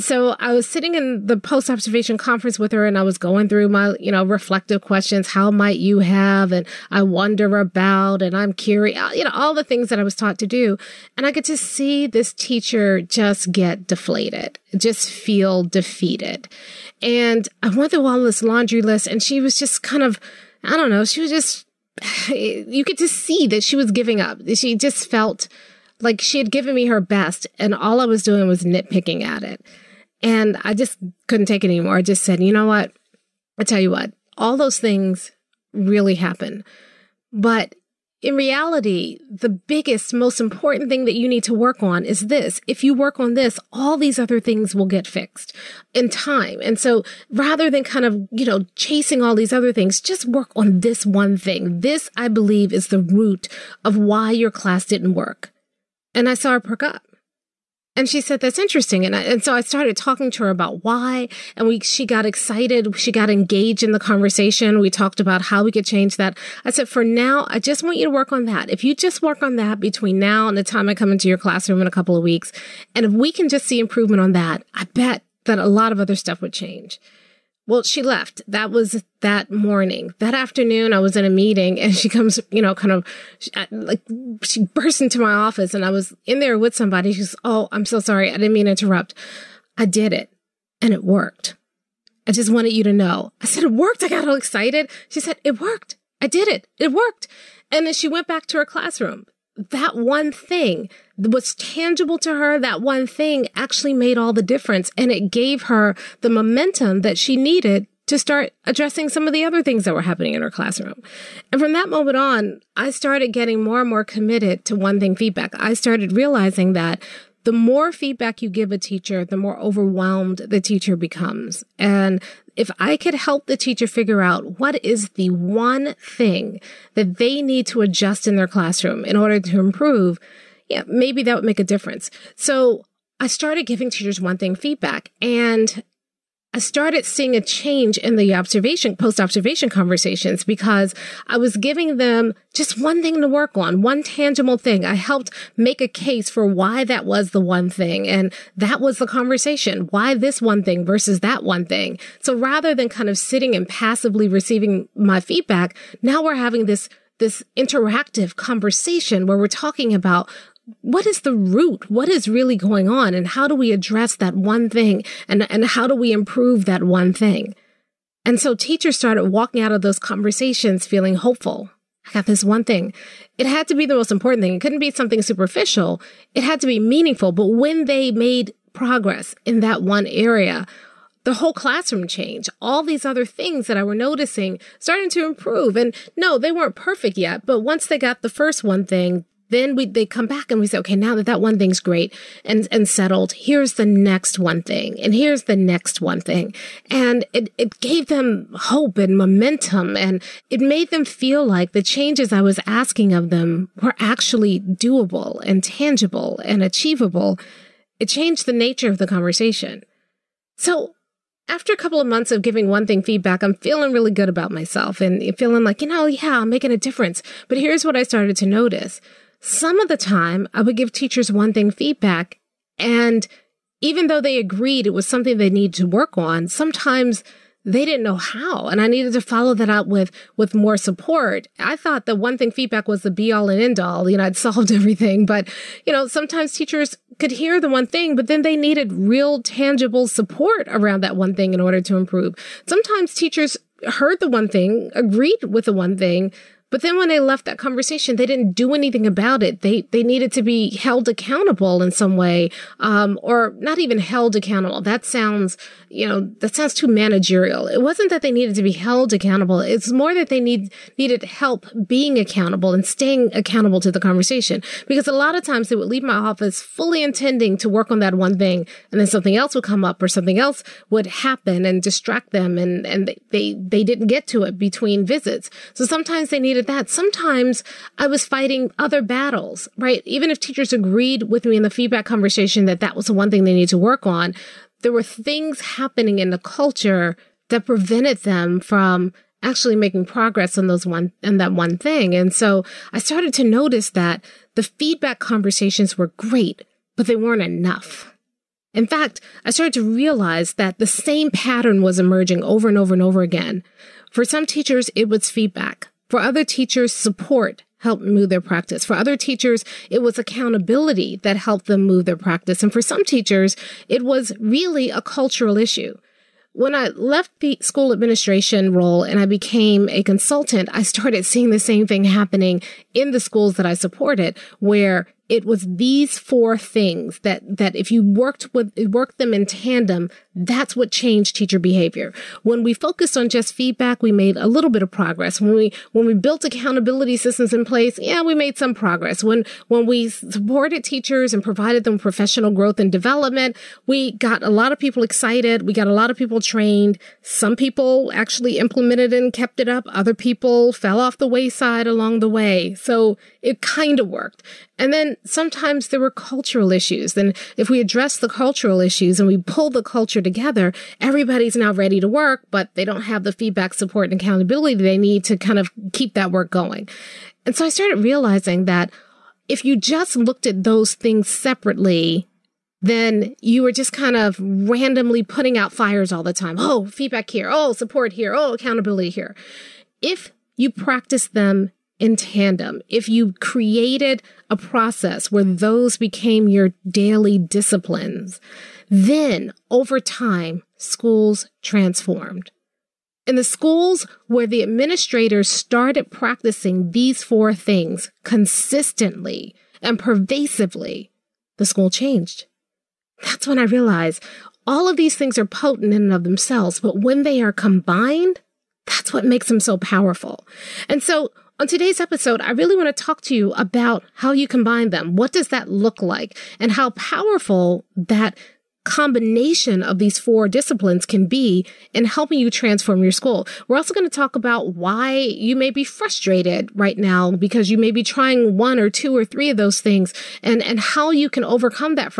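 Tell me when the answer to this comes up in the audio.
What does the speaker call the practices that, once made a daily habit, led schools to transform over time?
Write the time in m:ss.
6:26.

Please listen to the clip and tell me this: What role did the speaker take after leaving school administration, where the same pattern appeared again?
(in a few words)
consultant.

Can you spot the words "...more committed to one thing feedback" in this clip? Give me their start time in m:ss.
1:53.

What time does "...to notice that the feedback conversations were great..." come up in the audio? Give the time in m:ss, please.
4:53.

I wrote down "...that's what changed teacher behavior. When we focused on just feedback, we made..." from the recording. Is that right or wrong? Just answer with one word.
right.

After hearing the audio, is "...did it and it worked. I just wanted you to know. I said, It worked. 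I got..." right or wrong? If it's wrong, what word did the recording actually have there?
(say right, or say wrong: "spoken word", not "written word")
right.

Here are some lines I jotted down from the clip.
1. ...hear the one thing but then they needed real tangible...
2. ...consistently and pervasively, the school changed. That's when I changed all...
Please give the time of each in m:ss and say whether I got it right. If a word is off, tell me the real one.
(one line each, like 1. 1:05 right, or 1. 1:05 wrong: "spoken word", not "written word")
1. 3:57 right
2. 6:38 wrong: "realized", not "changed".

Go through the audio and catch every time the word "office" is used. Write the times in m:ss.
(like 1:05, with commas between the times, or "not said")
1:25, 4:26.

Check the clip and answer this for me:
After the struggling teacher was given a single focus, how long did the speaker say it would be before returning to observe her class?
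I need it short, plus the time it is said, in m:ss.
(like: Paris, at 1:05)
a couple of weeks, at 1:11.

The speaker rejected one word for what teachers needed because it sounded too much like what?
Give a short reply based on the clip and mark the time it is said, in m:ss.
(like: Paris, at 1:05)
managerial, at 4:16.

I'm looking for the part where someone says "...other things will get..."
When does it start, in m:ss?
0:44.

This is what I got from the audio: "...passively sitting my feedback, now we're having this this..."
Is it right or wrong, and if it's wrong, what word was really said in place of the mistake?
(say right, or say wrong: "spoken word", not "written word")
wrong: "receiving", not "sitting".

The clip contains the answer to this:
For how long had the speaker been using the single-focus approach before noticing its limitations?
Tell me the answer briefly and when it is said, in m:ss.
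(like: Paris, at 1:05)
a couple of months, at 3:31.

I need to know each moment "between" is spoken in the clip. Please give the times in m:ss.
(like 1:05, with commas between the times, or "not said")
1:09, 4:34.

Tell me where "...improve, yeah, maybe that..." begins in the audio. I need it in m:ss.
2:09.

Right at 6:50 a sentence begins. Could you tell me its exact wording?
And so on today's episode, I really want to talk to you about how you combine them.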